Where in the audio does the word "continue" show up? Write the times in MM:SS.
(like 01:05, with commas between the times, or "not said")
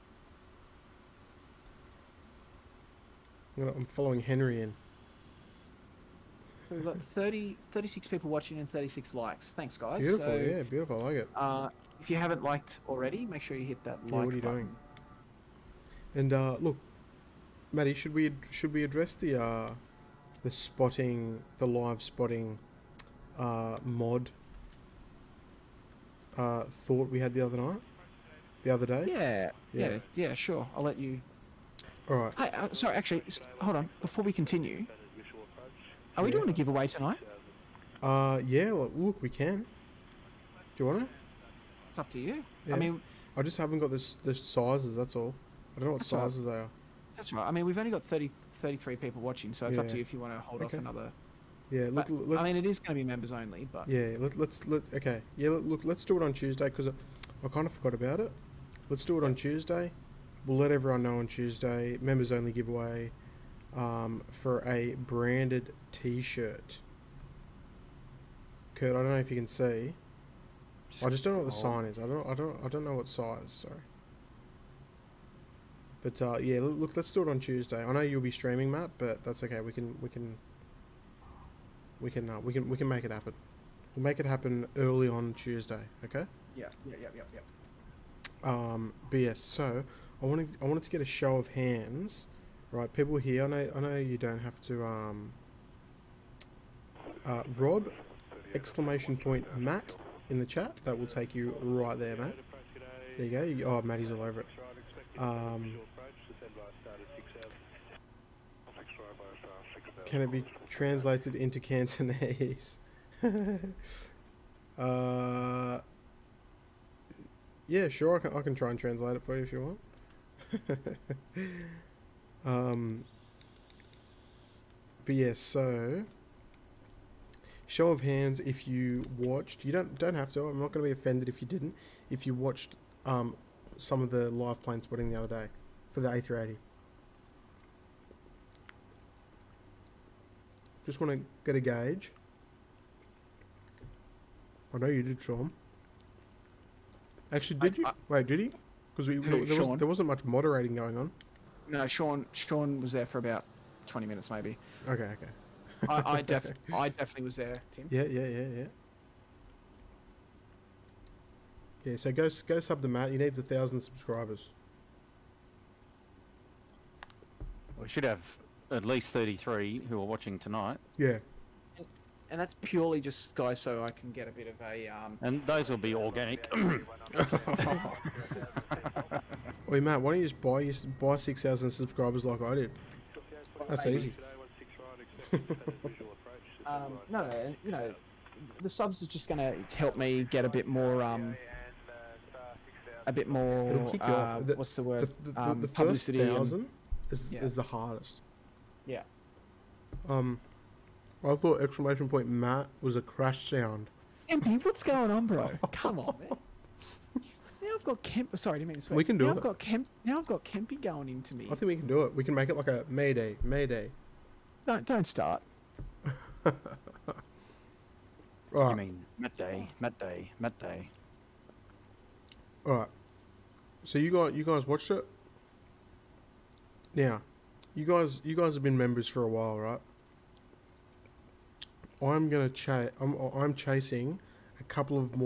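00:34.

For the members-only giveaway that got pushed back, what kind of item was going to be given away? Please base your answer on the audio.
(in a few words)
branded T-shirt.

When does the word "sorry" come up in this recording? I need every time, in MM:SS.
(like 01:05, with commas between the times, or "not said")
00:32, 01:13, 03:28.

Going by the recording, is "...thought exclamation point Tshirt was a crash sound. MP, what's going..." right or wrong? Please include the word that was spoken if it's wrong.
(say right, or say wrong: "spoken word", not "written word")
wrong: "Matt", not "Tshirt".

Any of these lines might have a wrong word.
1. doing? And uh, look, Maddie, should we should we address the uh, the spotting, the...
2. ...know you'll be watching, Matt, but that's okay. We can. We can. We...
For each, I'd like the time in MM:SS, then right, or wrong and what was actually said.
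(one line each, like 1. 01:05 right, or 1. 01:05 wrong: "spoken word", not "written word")
1. 00:14 right
2. 01:17 wrong: "streaming", not "watching".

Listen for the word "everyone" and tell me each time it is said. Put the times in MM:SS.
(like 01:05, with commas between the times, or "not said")
01:00.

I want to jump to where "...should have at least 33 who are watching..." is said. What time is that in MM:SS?
02:47.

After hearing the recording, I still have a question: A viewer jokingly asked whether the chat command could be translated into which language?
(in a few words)
Cantonese.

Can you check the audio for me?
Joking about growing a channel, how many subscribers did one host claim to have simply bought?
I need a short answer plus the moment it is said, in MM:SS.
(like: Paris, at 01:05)
6000, at 03:01.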